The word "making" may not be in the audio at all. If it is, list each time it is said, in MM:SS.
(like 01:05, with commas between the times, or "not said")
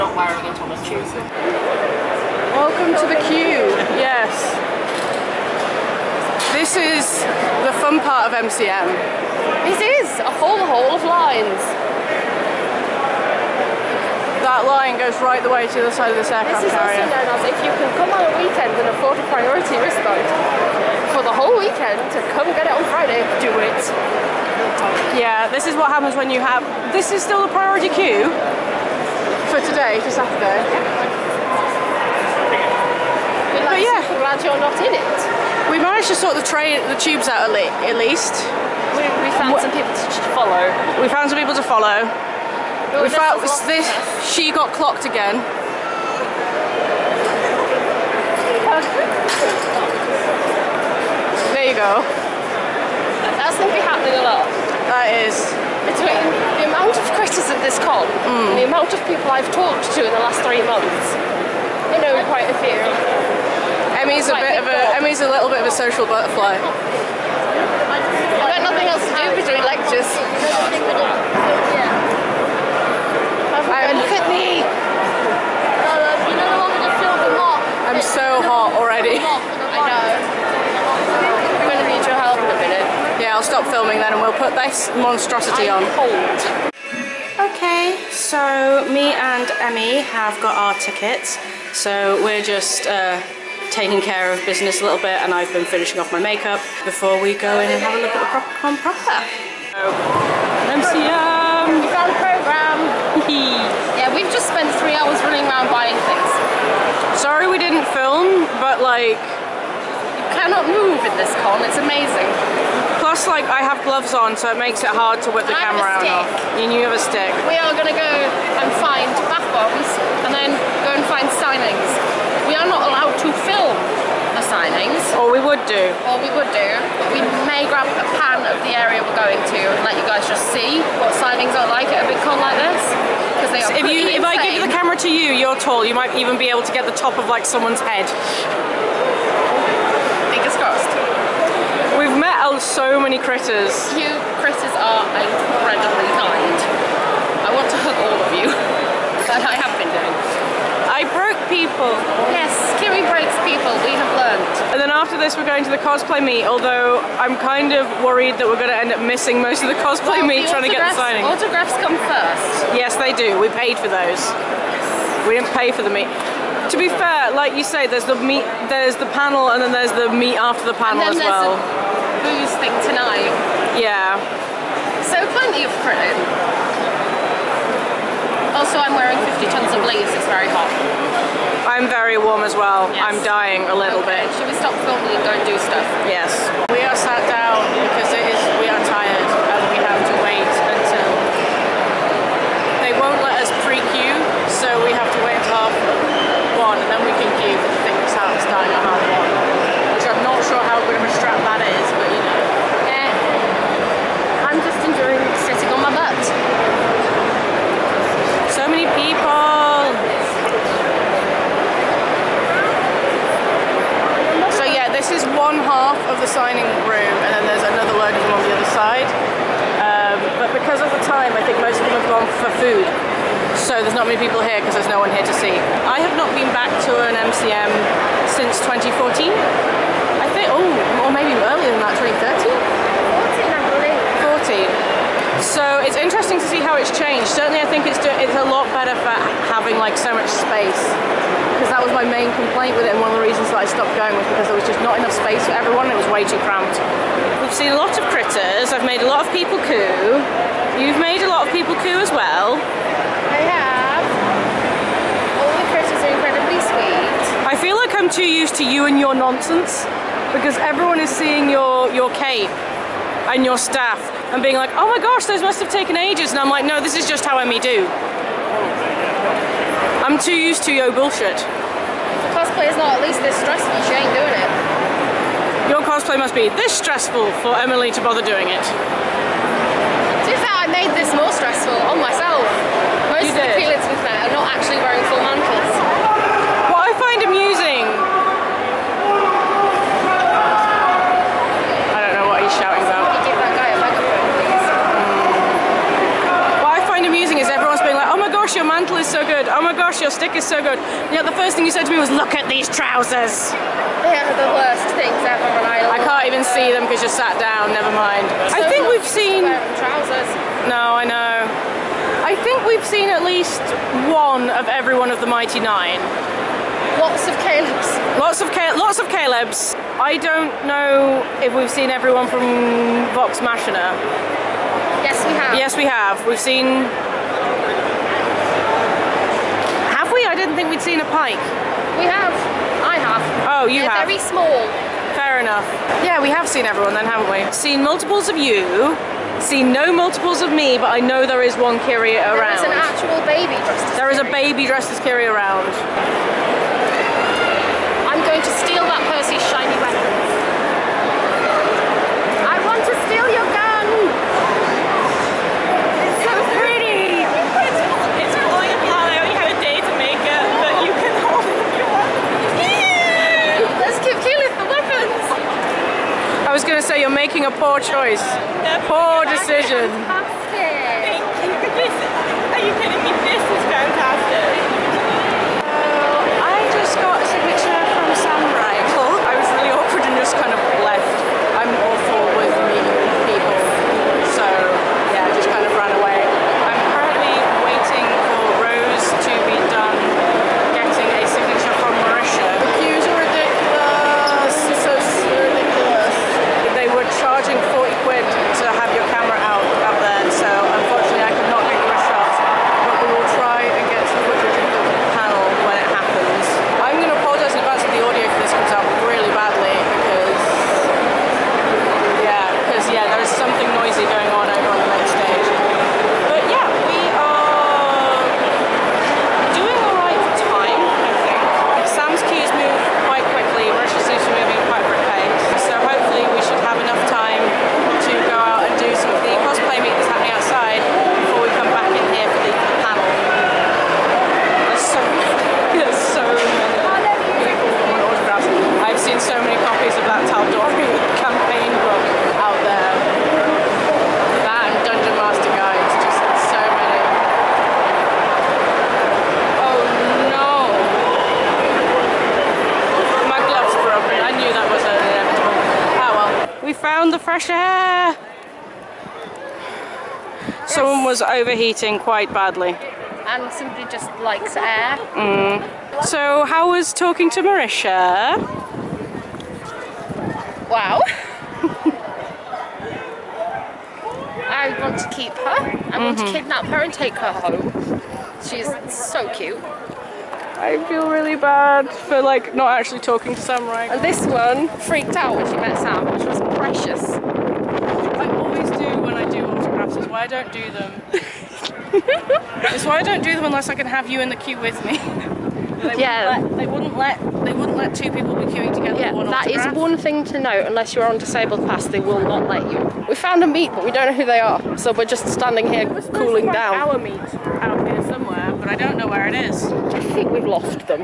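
06:07.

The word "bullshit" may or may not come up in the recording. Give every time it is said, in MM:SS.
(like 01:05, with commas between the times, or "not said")
04:30.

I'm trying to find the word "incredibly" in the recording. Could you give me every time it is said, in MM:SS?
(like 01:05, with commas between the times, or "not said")
02:25, 04:16.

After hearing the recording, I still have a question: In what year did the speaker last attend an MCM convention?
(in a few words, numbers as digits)
2014.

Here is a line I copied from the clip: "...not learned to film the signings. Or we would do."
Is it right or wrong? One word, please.
wrong.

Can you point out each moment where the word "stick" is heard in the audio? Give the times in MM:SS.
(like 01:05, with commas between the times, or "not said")
01:57, 05:00.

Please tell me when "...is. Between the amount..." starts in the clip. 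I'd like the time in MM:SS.
00:55.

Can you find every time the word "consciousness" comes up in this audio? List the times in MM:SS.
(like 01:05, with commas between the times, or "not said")
not said.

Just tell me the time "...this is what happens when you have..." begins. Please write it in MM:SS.
00:25.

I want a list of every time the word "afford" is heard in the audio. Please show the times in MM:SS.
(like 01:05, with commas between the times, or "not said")
00:18.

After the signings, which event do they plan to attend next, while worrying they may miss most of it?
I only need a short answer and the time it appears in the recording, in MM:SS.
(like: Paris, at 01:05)
The cosplay meet, at 02:35.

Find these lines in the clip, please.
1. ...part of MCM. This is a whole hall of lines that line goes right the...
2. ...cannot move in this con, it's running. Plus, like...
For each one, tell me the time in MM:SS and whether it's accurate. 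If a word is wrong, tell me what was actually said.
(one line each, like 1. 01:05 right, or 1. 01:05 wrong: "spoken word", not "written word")
1. 00:08 right
2. 01:50 wrong: "amazing", not "running".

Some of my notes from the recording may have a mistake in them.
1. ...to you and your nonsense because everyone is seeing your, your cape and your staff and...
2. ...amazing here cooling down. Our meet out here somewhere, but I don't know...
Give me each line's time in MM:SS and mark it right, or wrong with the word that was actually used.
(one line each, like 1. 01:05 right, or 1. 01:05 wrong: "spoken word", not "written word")
1. 04:18 right
2. 08:25 wrong: "standing", not "amazing".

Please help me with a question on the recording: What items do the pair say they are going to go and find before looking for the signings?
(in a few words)
Bath bombs.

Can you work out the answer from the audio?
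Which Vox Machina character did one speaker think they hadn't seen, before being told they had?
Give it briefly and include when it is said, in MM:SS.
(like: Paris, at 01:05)
Pike, at 05:31.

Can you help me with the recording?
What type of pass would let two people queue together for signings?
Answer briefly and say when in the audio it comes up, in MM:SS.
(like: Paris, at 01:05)
Disabled pass, at 08:21.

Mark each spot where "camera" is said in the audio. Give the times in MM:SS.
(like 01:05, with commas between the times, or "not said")
01:55, 02:14.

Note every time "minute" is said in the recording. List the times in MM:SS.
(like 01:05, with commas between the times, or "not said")
01:22.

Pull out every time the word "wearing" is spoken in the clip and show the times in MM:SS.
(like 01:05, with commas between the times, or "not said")
00:00, 02:58, 04:44.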